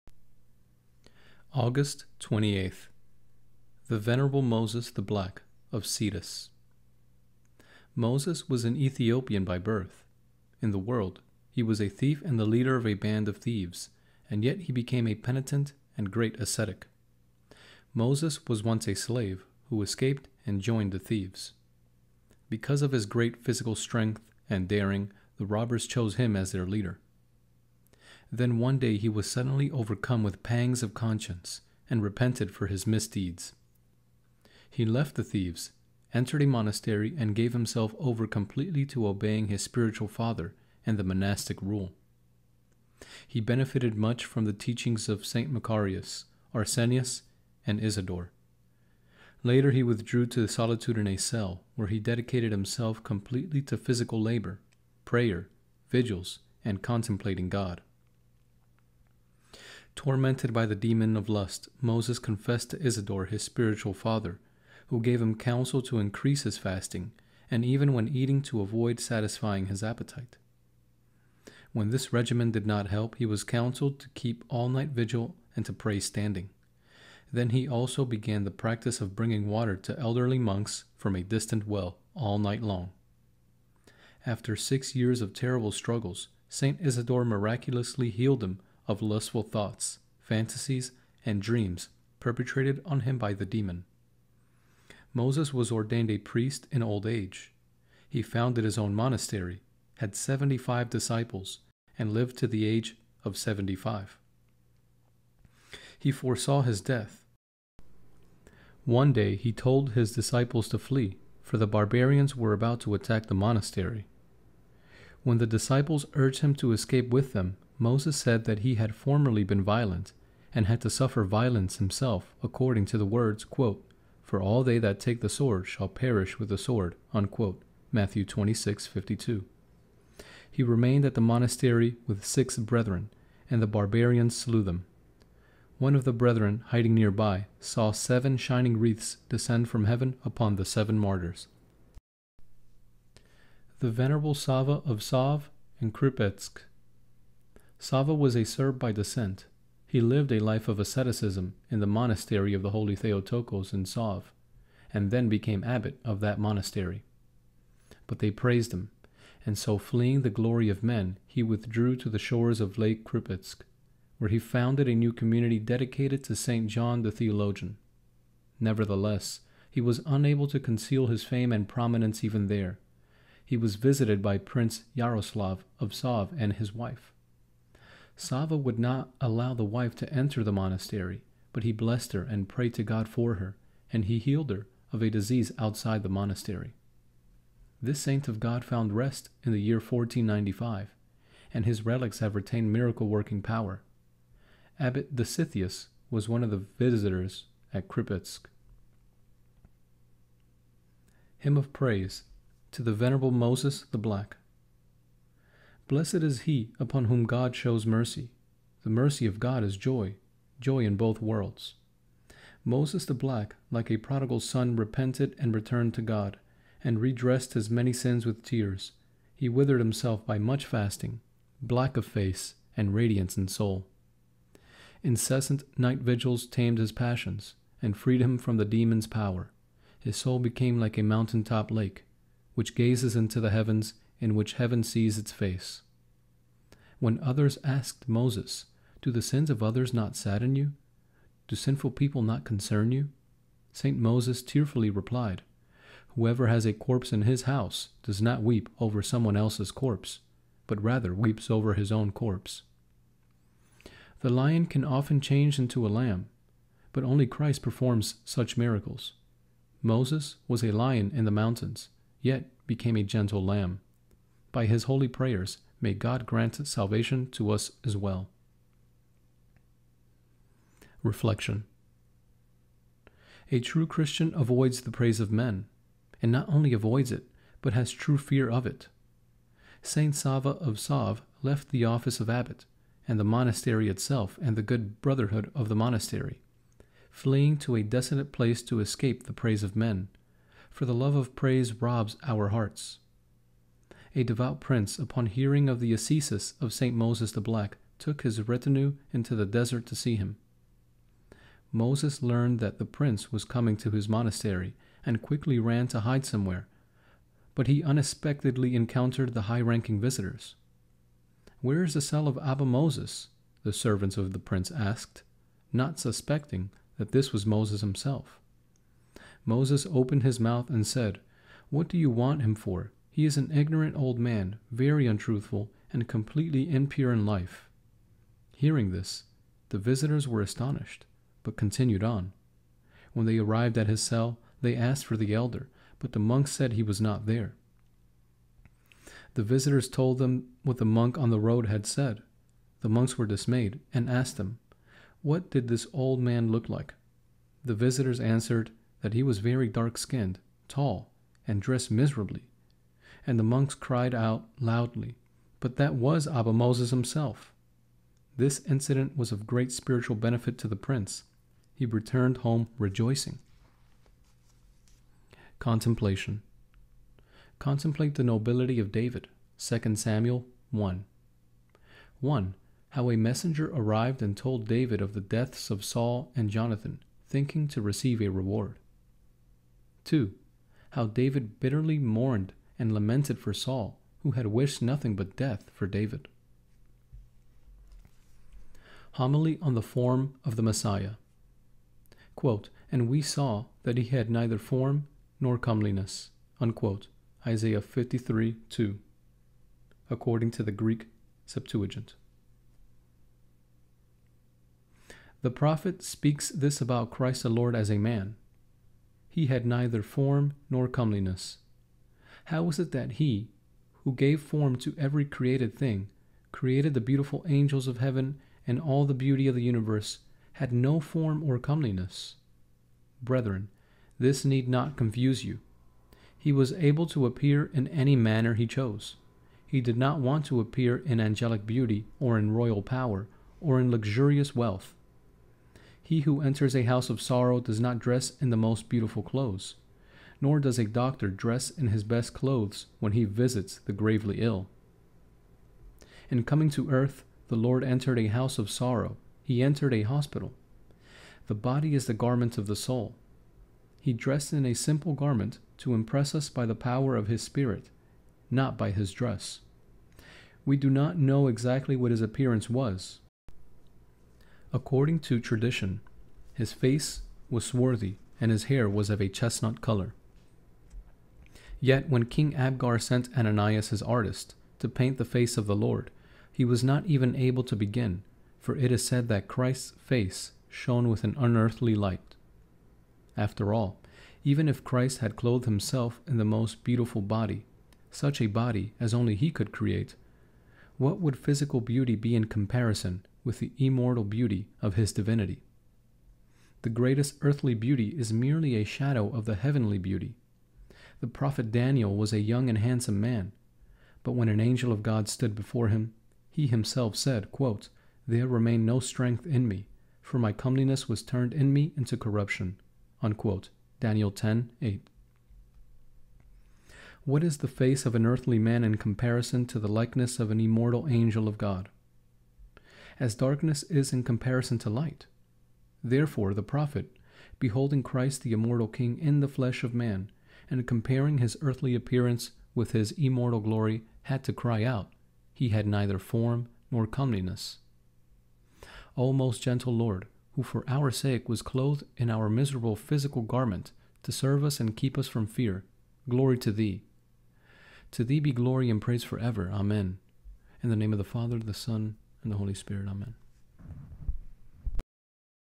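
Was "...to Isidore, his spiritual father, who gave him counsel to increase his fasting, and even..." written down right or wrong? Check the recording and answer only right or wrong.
right.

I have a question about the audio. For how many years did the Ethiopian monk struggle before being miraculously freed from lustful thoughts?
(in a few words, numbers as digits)
6.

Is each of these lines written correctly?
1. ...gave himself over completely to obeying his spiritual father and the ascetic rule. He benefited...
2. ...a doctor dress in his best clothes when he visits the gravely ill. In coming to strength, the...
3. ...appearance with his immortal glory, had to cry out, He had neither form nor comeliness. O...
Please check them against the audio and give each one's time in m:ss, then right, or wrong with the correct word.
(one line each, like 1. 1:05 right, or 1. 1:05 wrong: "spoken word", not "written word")
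1. 0:37 wrong: "monastic", not "ascetic"
2. 7:20 wrong: "earth", not "strength"
3. 8:51 right.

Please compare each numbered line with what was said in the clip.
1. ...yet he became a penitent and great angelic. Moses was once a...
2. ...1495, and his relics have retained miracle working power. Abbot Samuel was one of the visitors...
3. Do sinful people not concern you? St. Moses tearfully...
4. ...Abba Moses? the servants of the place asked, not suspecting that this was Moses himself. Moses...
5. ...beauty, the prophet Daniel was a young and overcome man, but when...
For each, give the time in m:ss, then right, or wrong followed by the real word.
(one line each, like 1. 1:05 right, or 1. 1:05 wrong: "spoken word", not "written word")
1. 0:14 wrong: "ascetic", not "angelic"
2. 3:09 wrong: "Dositheus", not "Samuel"
3. 4:01 right
4. 5:12 wrong: "prince", not "place"
5. 8:19 wrong: "handsome", not "overcome".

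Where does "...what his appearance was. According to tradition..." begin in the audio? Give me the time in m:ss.
7:41.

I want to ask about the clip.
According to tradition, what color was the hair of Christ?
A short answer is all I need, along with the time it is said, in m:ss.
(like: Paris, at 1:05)
chestnut, at 7:49.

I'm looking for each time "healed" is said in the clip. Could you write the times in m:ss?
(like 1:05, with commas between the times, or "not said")
1:28, 3:04.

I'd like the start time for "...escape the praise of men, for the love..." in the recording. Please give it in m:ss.
4:48.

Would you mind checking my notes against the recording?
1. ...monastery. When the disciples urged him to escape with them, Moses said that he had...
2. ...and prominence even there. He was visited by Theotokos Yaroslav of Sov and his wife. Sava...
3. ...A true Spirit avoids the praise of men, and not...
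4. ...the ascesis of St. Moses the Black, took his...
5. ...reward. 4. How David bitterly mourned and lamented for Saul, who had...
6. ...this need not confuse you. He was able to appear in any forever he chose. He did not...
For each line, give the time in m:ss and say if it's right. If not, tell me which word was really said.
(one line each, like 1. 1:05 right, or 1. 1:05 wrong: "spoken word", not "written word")
1. 1:53 right
2. 2:51 wrong: "Prince", not "Theotokos"
3. 4:33 wrong: "Christian", not "Spirit"
4. 4:55 right
5. 6:18 wrong: "2", not "4"
6. 7:04 wrong: "manner", not "forever".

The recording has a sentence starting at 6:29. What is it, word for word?
Homily on the Form of the Messiah.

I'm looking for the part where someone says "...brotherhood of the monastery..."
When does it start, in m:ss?
4:45.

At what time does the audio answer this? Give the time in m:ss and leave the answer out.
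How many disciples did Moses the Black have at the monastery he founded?
1:40.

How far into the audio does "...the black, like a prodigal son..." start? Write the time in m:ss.
3:33.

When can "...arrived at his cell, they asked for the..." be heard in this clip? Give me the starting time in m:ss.
5:33.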